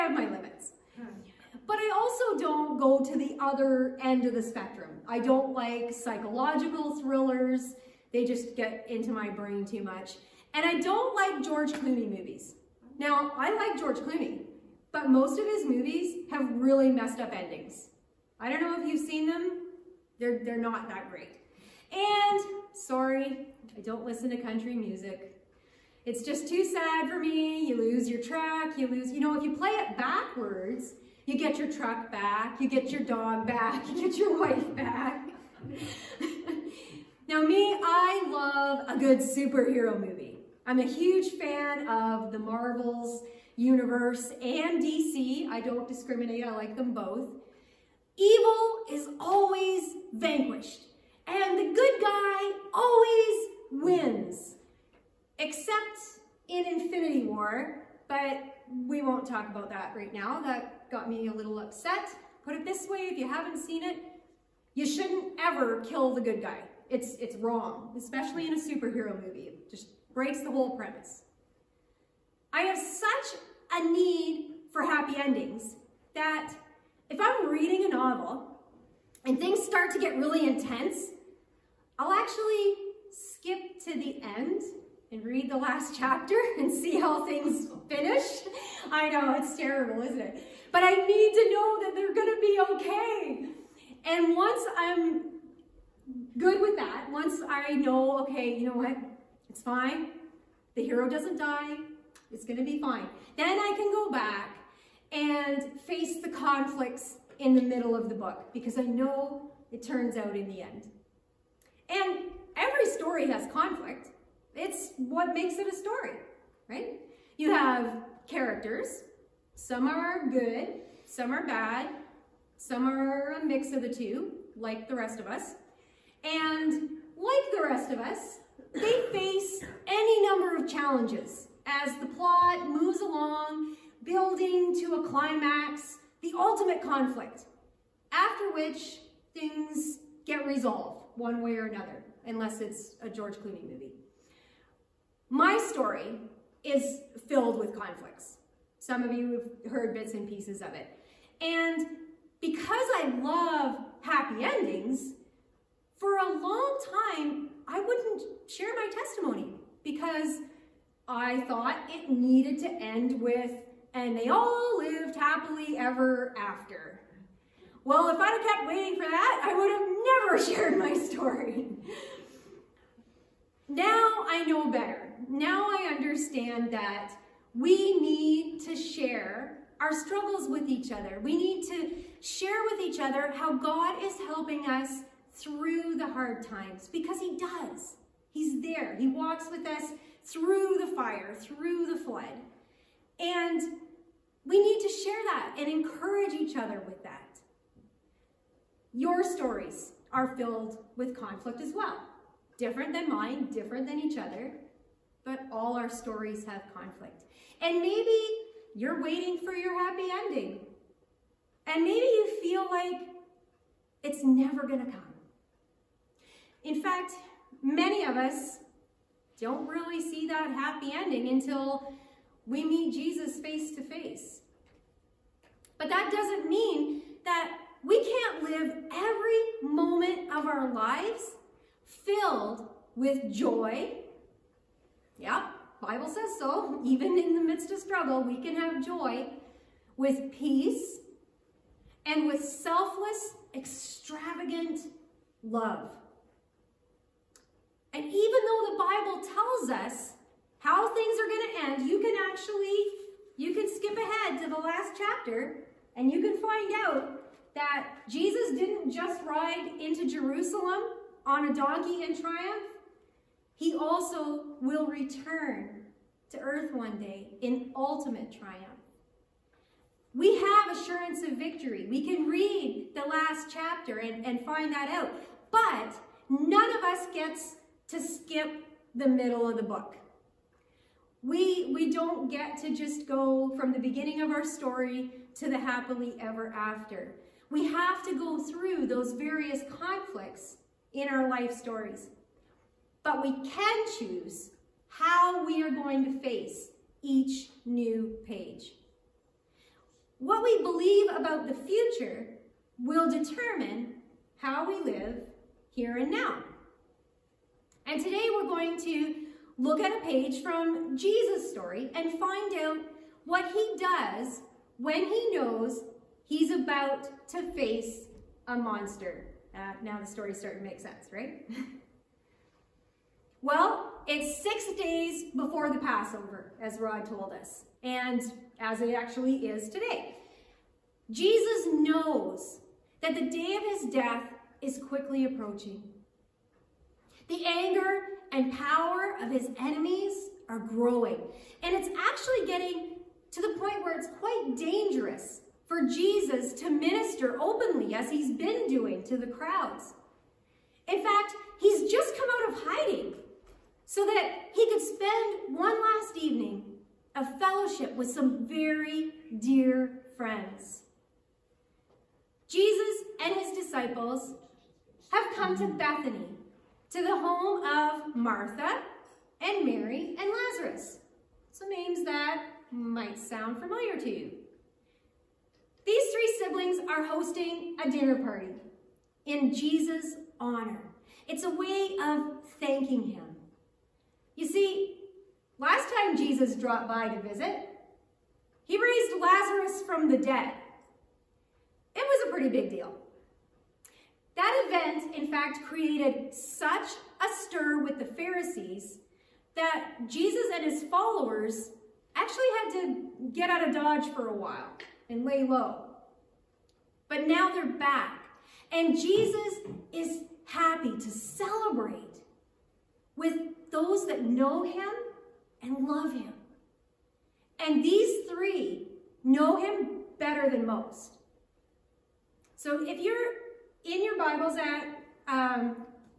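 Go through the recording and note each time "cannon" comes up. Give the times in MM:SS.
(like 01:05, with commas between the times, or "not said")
not said.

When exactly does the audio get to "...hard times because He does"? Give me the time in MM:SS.
03:06.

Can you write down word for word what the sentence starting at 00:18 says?
I don't know if you've seen them, they're, they're not that great.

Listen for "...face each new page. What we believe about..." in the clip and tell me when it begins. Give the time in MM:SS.
04:56.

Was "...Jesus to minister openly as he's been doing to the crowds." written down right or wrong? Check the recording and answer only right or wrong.
right.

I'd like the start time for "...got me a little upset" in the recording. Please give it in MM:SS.
01:00.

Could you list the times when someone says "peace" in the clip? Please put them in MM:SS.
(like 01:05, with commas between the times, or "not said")
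04:00.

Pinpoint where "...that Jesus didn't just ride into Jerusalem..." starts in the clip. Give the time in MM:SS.
04:17.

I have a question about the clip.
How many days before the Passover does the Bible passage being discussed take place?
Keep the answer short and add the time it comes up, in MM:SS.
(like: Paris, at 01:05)
6, at 05:24.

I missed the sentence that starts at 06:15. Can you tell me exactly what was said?
These three siblings are hosting a dinner party in Jesus' honor.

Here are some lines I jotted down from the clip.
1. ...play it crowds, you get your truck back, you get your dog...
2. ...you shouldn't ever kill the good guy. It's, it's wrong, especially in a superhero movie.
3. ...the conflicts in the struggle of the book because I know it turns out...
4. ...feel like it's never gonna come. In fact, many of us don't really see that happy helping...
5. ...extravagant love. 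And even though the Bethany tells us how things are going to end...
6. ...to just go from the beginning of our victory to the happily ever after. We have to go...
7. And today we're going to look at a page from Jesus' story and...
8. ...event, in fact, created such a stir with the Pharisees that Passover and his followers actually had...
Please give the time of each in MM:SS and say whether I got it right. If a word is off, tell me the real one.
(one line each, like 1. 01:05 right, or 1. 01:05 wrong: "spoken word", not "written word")
1. 00:29 wrong: "backwards", not "crowds"
2. 01:04 right
3. 01:46 wrong: "middle", not "struggle"
4. 03:32 wrong: "ending", not "helping"
5. 04:03 wrong: "Bible", not "Bethany"
6. 04:42 wrong: "story", not "victory"
7. 05:07 right
8. 06:34 wrong: "Jesus", not "Passover".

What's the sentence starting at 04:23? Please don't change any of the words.
He also will return to earth one day in ultimate triumph.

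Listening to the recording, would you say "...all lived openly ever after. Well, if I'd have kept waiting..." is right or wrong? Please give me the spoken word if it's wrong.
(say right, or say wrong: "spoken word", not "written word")
wrong: "happily", not "openly".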